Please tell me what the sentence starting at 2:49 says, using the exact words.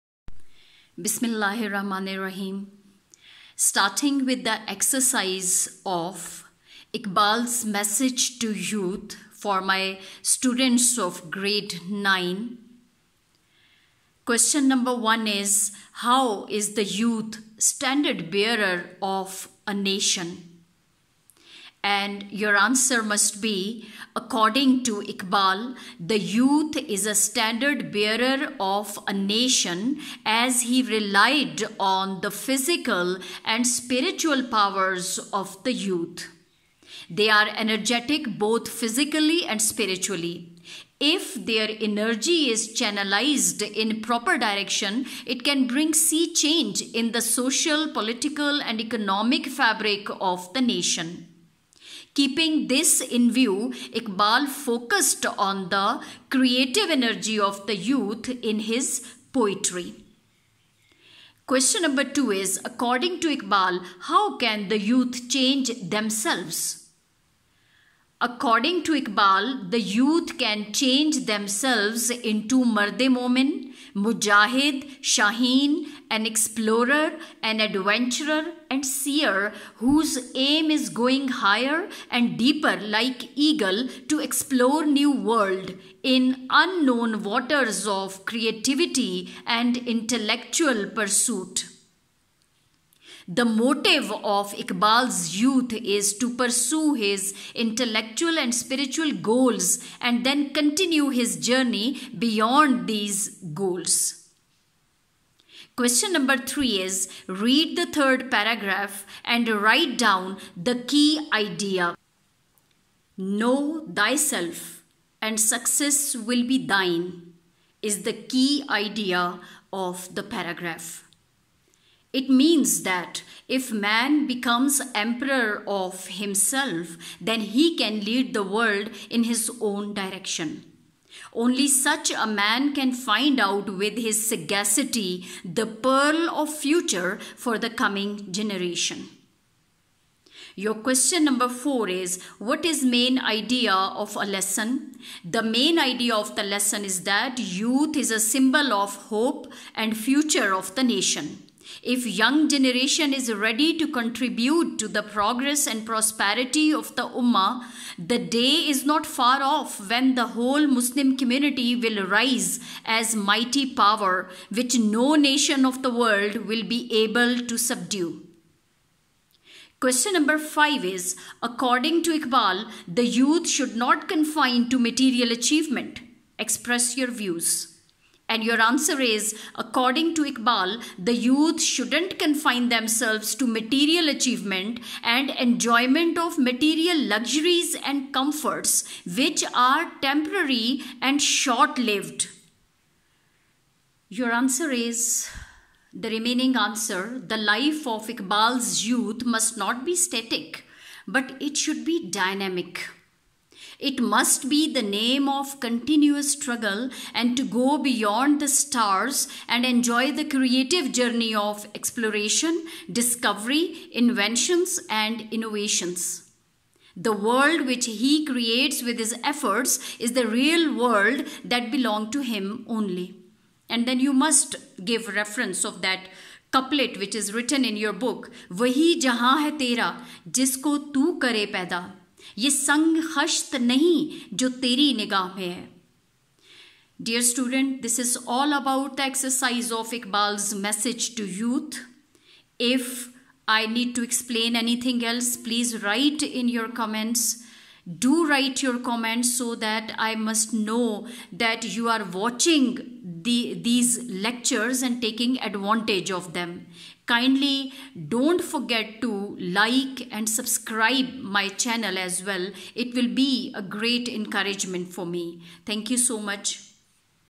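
Question number five is According to Iqbal, the youth should not confine to material achievement.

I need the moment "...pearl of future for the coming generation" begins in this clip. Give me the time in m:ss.
2:15.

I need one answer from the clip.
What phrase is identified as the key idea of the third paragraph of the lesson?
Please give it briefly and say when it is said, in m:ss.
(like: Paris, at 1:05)
Know thyself, at 1:53.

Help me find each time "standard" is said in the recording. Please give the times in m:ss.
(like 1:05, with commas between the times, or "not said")
0:17, 0:27.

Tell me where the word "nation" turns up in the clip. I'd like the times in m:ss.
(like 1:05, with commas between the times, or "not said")
0:19, 0:29, 0:50, 2:30, 2:45.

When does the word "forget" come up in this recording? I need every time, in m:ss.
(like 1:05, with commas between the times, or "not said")
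4:18.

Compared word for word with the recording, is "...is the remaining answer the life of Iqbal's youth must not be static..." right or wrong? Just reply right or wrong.
right.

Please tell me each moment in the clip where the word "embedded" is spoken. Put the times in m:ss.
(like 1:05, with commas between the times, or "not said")
not said.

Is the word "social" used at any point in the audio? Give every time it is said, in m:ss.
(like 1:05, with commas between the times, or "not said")
0:47.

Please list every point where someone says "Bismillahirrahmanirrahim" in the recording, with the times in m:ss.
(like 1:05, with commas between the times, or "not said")
0:01.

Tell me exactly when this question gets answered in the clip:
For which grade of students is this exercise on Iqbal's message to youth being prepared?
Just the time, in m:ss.
0:11.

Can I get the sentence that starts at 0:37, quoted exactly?
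They are energetic both physically and spiritually.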